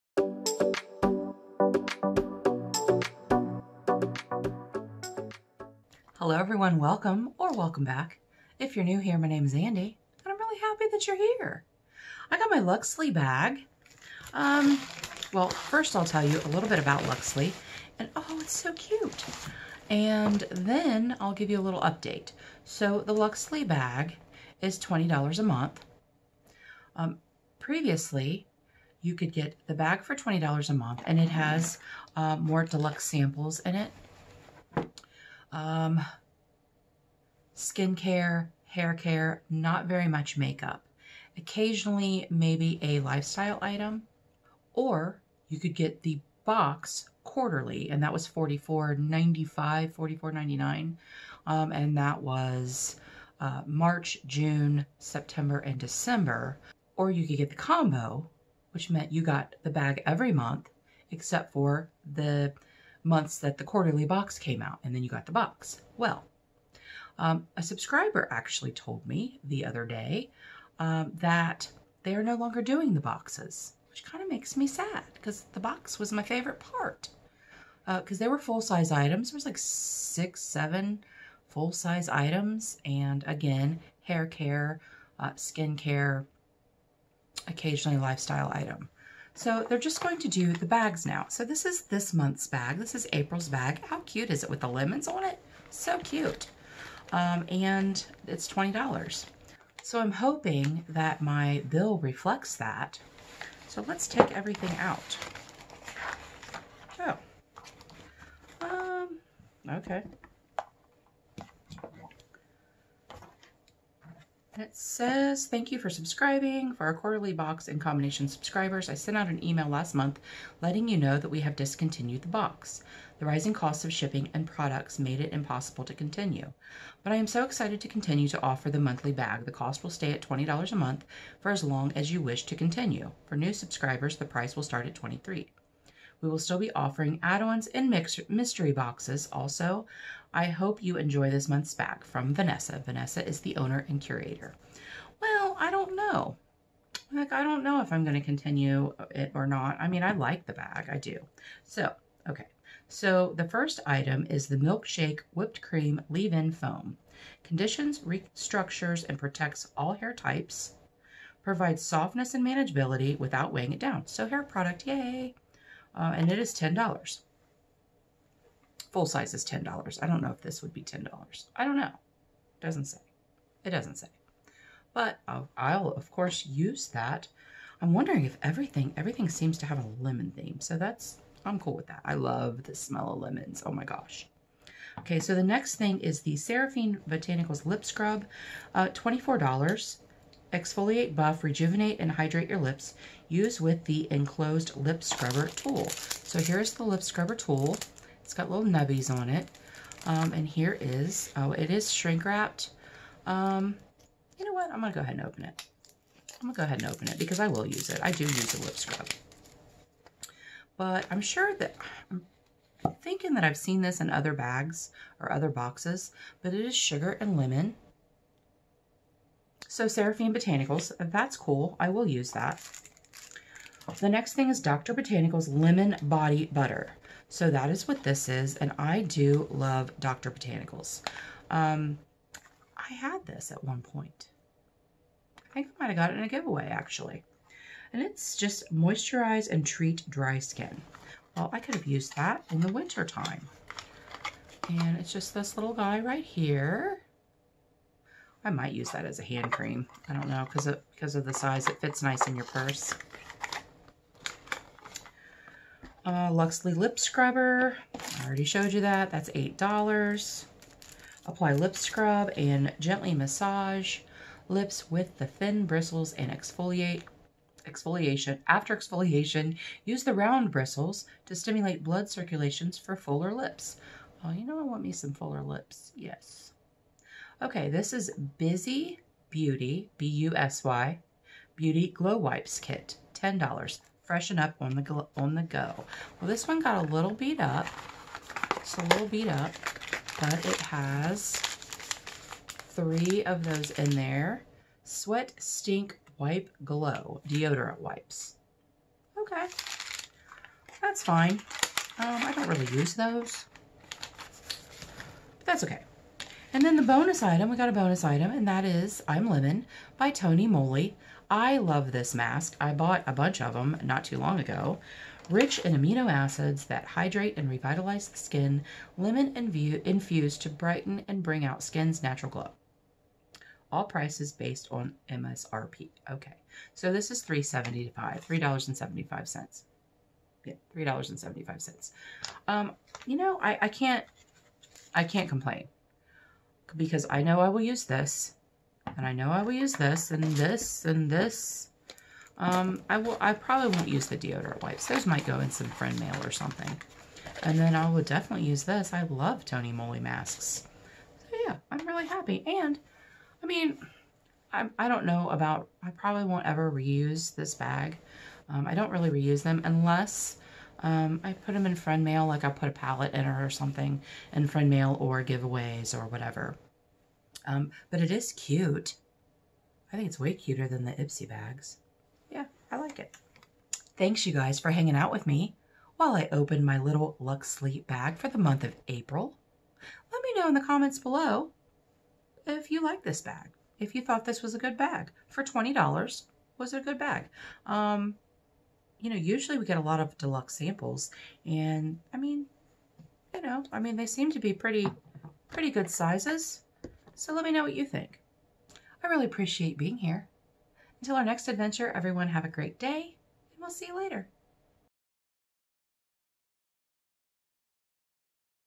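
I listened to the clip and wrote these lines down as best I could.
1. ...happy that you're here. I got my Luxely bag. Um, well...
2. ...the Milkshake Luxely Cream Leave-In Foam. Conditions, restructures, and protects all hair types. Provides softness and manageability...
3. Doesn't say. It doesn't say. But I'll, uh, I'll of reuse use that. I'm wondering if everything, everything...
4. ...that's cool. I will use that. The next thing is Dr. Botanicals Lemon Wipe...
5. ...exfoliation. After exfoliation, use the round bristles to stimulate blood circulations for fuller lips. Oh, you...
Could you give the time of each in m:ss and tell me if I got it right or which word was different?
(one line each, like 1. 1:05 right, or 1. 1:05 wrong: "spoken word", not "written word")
1. 0:10 right
2. 2:34 wrong: "Whipped", not "Luxely"
3. 2:52 wrong: "course", not "reuse"
4. 3:41 wrong: "Body", not "Wipe"
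5. 4:27 right.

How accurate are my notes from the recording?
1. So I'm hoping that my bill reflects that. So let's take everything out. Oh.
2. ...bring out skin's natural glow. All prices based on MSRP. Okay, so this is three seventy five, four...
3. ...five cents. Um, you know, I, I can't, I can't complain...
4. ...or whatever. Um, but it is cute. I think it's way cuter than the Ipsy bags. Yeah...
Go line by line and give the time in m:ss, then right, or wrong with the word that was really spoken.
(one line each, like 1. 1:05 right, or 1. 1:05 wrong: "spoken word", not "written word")
1. 1:39 right
2. 5:21 wrong: "three", not "four"
3. 5:31 right
4. 6:05 right.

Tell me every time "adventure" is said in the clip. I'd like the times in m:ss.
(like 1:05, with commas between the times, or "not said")
6:41.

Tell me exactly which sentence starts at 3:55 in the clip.
I think I might have got it in a giveaway, actually.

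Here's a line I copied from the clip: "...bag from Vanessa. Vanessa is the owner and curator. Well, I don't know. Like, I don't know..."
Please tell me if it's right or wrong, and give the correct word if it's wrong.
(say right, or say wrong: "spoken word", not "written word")
right.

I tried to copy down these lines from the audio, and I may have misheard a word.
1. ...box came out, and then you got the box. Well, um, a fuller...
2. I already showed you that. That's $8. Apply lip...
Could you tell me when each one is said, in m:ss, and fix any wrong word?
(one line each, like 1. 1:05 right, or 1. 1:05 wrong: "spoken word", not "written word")
1. 1:04 wrong: "subscriber", not "fuller"
2. 4:18 right.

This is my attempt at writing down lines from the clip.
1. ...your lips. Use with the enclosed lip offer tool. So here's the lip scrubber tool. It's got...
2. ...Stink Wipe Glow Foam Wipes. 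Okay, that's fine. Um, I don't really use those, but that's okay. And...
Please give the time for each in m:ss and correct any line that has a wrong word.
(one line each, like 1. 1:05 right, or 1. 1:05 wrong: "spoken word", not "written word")
1. 3:12 wrong: "scrubber", not "offer"
2. 4:55 wrong: "Deodorant", not "Foam".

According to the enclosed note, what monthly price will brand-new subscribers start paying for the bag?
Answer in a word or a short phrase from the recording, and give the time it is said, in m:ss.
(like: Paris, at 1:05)
23, at 2:14.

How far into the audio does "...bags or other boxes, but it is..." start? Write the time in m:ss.
3:34.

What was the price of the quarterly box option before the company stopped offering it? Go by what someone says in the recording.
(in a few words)
$44.95.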